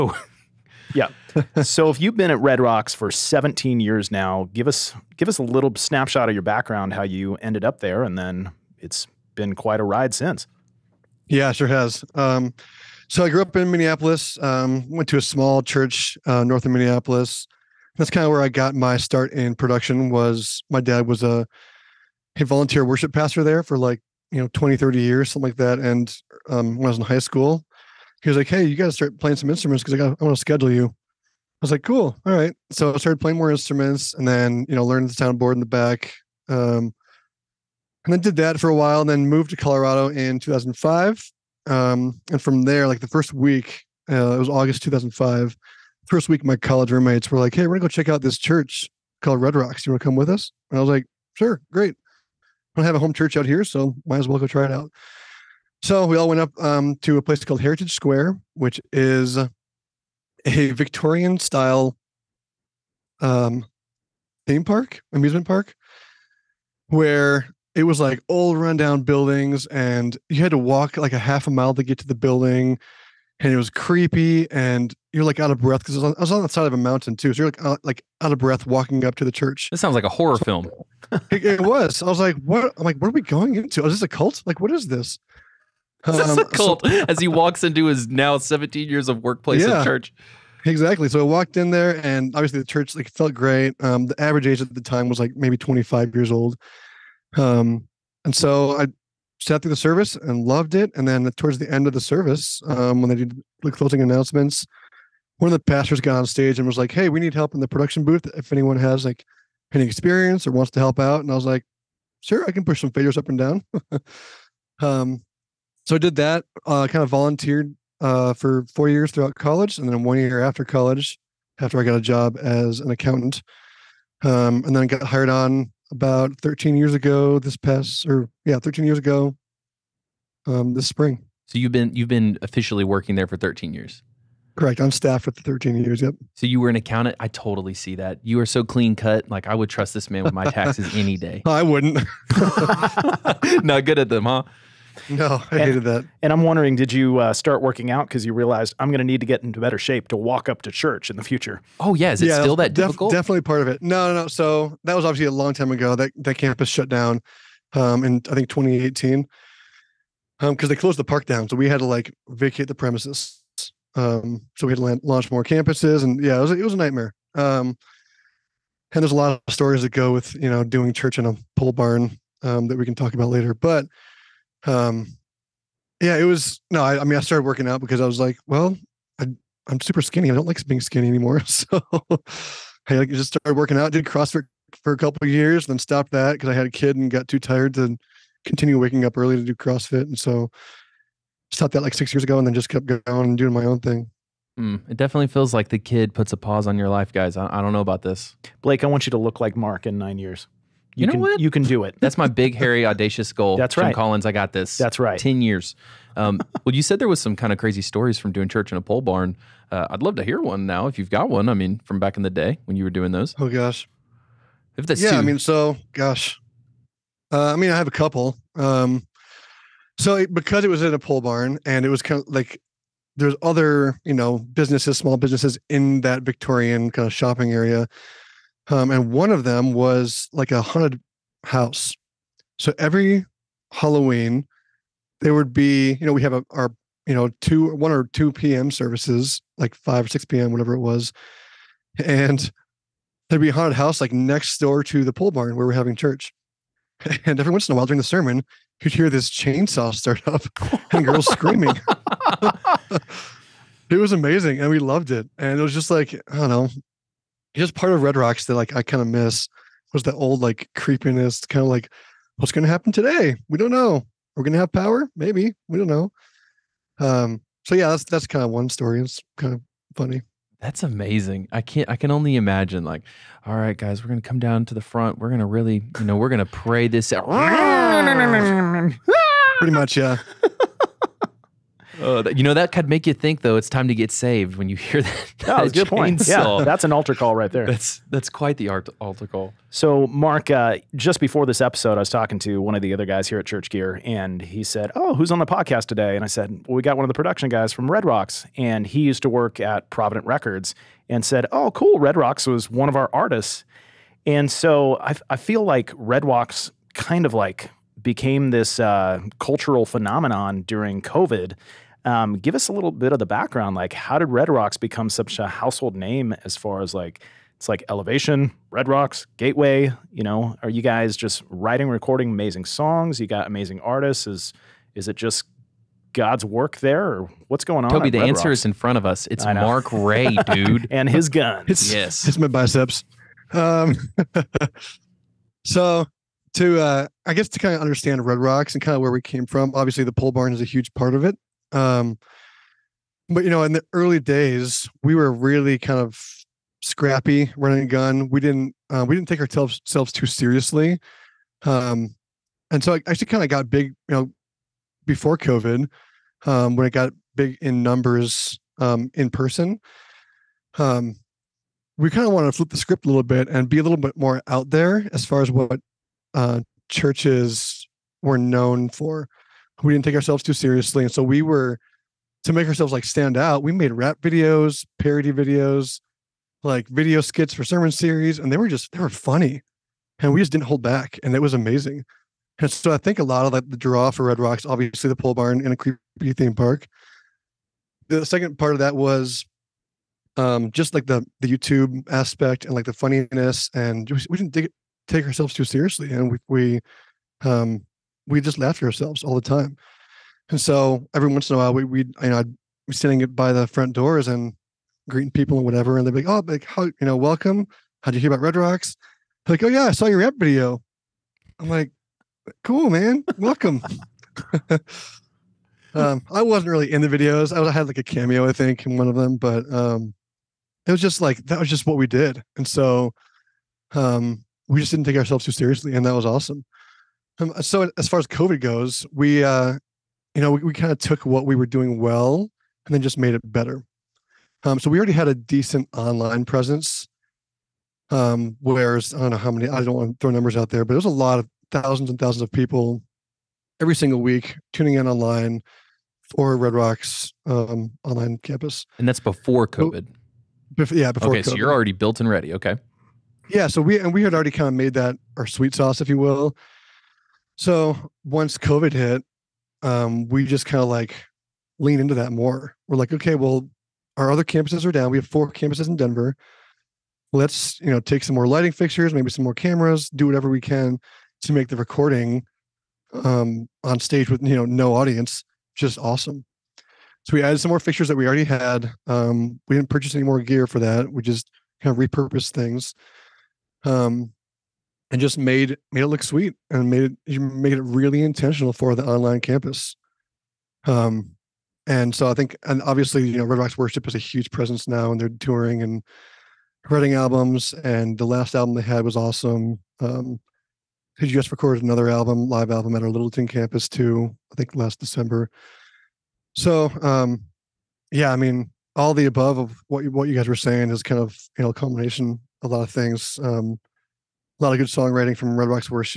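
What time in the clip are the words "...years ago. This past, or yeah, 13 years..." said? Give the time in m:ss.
2:06.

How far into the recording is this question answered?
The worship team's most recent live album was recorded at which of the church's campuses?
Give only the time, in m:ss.
8:23.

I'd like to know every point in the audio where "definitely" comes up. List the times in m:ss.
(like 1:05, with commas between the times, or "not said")
2:33, 3:14.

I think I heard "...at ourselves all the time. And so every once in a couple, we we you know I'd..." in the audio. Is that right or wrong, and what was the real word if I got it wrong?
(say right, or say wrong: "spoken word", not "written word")
wrong: "while", not "couple".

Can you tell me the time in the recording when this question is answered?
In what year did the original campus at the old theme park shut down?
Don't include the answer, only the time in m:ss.
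2:38.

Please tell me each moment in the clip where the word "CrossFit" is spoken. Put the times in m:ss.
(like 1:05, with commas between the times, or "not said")
3:04, 3:09.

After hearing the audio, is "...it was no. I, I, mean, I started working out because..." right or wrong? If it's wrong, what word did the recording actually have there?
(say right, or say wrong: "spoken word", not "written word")
right.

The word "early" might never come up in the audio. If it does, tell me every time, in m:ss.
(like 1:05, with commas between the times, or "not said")
3:09, 5:43.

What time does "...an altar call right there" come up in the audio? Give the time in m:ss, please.
4:46.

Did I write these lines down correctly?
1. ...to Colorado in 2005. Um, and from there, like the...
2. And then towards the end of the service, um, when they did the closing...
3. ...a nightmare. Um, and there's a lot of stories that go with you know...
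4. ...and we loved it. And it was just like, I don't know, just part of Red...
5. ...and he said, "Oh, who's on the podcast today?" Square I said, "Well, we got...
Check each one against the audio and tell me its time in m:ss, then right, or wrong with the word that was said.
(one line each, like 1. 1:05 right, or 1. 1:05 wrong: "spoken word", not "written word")
1. 0:39 right
2. 1:40 right
3. 2:46 right
4. 4:14 right
5. 4:54 wrong: "And", not "Square".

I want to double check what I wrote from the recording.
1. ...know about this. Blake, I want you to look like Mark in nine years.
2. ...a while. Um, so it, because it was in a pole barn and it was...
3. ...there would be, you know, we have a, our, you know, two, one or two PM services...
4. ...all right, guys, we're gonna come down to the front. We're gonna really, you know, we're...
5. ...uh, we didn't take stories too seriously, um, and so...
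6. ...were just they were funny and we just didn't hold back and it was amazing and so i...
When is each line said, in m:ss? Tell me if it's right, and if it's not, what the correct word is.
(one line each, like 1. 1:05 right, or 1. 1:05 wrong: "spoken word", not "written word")
1. 3:17 right
2. 3:37 wrong: "couple", not "while"
3. 3:55 right
4. 4:33 right
5. 5:48 wrong: "ourselves", not "stories"
6. 6:18 right.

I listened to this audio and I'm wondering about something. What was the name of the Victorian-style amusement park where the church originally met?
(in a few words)
Heritage Square.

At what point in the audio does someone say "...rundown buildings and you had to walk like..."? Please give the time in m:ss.
1:08.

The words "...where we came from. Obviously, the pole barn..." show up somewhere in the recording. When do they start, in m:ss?
5:39.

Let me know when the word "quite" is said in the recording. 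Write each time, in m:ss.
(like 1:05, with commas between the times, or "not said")
0:09, 4:48.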